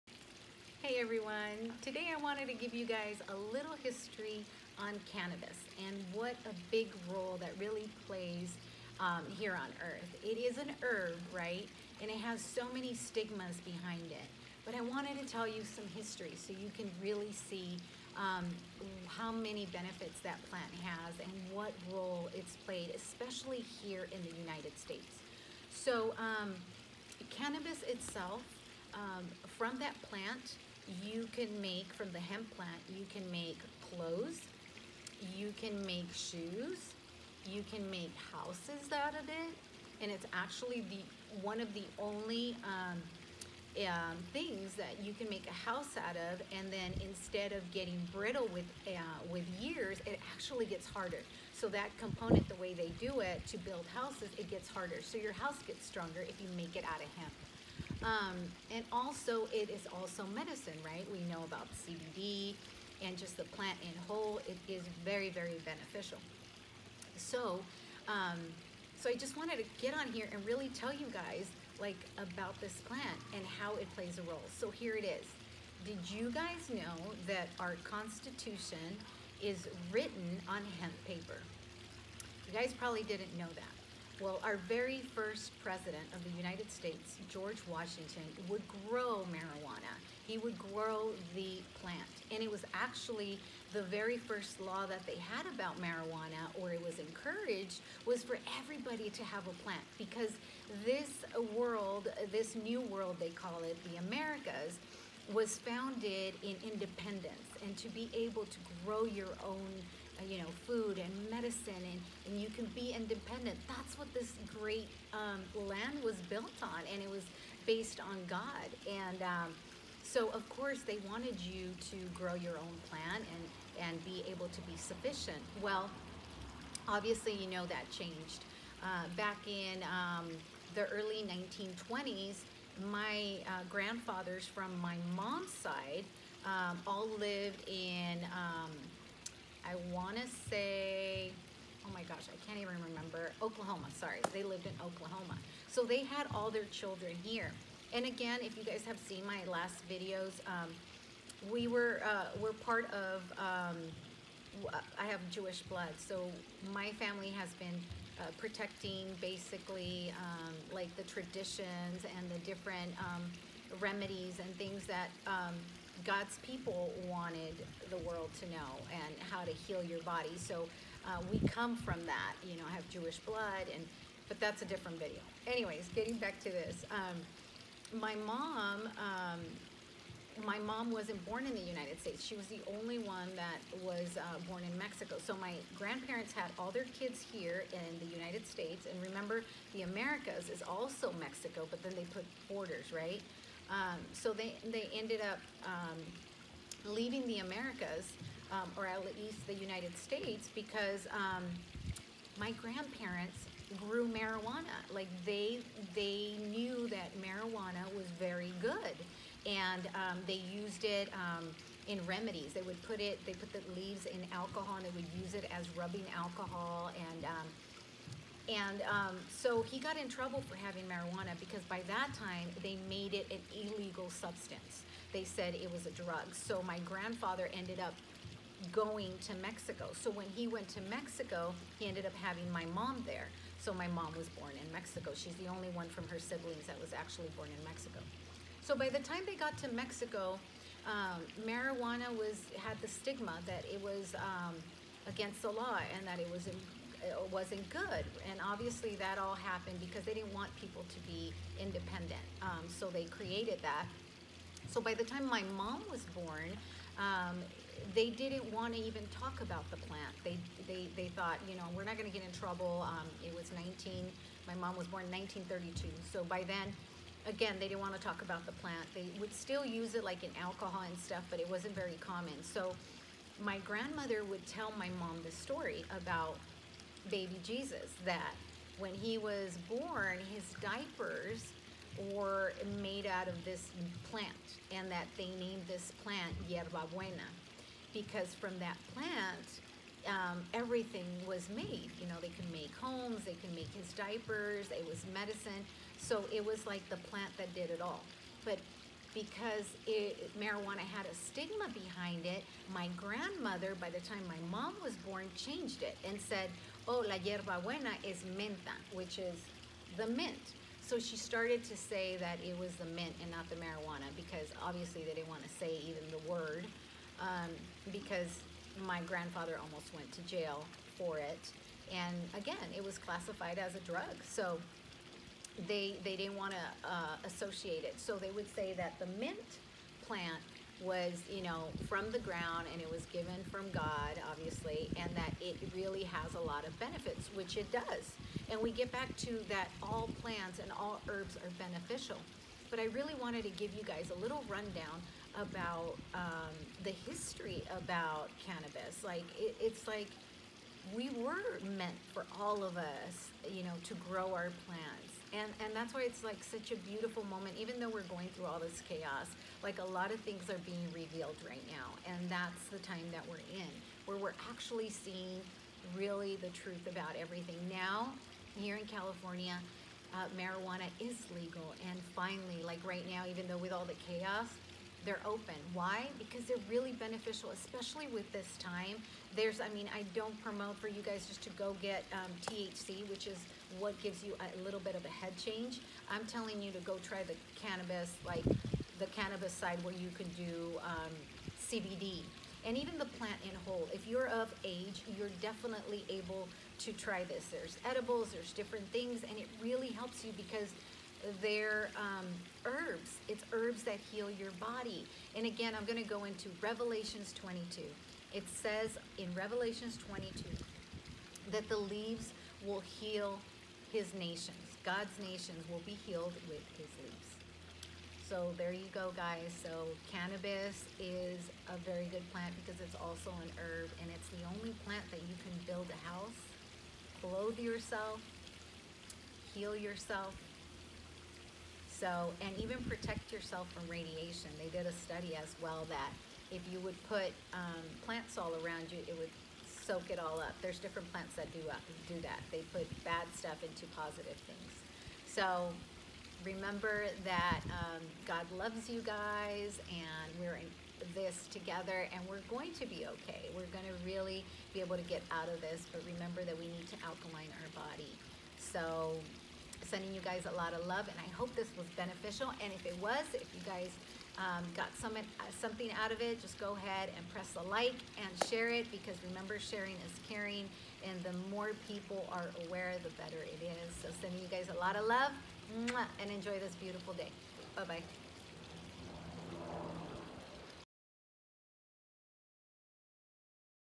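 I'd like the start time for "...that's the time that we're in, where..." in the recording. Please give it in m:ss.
6:02.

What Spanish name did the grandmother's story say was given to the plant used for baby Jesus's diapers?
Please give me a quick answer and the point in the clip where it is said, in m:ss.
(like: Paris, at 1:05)
yerba buena, at 4:46.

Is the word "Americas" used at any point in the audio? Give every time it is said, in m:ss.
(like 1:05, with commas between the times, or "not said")
1:43, 3:09, 3:17.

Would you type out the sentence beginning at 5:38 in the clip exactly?
And we get back to that all plants and all herbs are beneficial.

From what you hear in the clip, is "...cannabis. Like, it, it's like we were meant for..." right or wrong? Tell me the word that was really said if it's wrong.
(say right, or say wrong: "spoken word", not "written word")
right.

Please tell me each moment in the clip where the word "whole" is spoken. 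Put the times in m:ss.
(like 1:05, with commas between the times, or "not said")
1:04, 6:33.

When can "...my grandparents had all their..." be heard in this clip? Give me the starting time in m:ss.
3:05.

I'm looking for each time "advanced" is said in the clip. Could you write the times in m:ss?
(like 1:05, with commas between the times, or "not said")
not said.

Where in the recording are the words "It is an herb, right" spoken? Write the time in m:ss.
0:10.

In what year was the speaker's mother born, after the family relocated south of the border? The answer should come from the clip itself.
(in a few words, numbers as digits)
1932.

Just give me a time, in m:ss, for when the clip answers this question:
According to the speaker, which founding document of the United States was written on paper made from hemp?
1:17.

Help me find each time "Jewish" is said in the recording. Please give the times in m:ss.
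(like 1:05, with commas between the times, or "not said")
2:35, 2:52.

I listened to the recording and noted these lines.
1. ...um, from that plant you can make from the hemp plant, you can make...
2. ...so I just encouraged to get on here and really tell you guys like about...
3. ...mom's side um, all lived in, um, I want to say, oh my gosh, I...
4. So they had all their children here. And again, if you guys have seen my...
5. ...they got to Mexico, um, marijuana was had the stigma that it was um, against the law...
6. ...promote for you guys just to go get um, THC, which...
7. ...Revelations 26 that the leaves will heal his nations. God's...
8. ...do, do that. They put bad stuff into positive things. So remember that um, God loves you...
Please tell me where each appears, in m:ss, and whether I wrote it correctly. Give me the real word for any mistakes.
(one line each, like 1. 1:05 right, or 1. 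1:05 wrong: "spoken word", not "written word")
1. 0:28 right
2. 1:08 wrong: "wanted", not "encouraged"
3. 2:15 right
4. 2:25 right
5. 3:59 right
6. 6:20 right
7. 6:49 wrong: "22", not "26"
8. 7:21 right.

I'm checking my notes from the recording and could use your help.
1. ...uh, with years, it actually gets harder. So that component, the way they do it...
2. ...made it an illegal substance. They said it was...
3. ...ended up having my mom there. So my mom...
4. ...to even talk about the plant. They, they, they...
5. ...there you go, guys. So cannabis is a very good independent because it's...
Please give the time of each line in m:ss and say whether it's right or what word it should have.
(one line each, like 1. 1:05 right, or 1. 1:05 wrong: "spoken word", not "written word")
1. 0:48 right
2. 3:42 right
3. 3:51 right
4. 4:18 right
5. 6:58 wrong: "plant", not "independent".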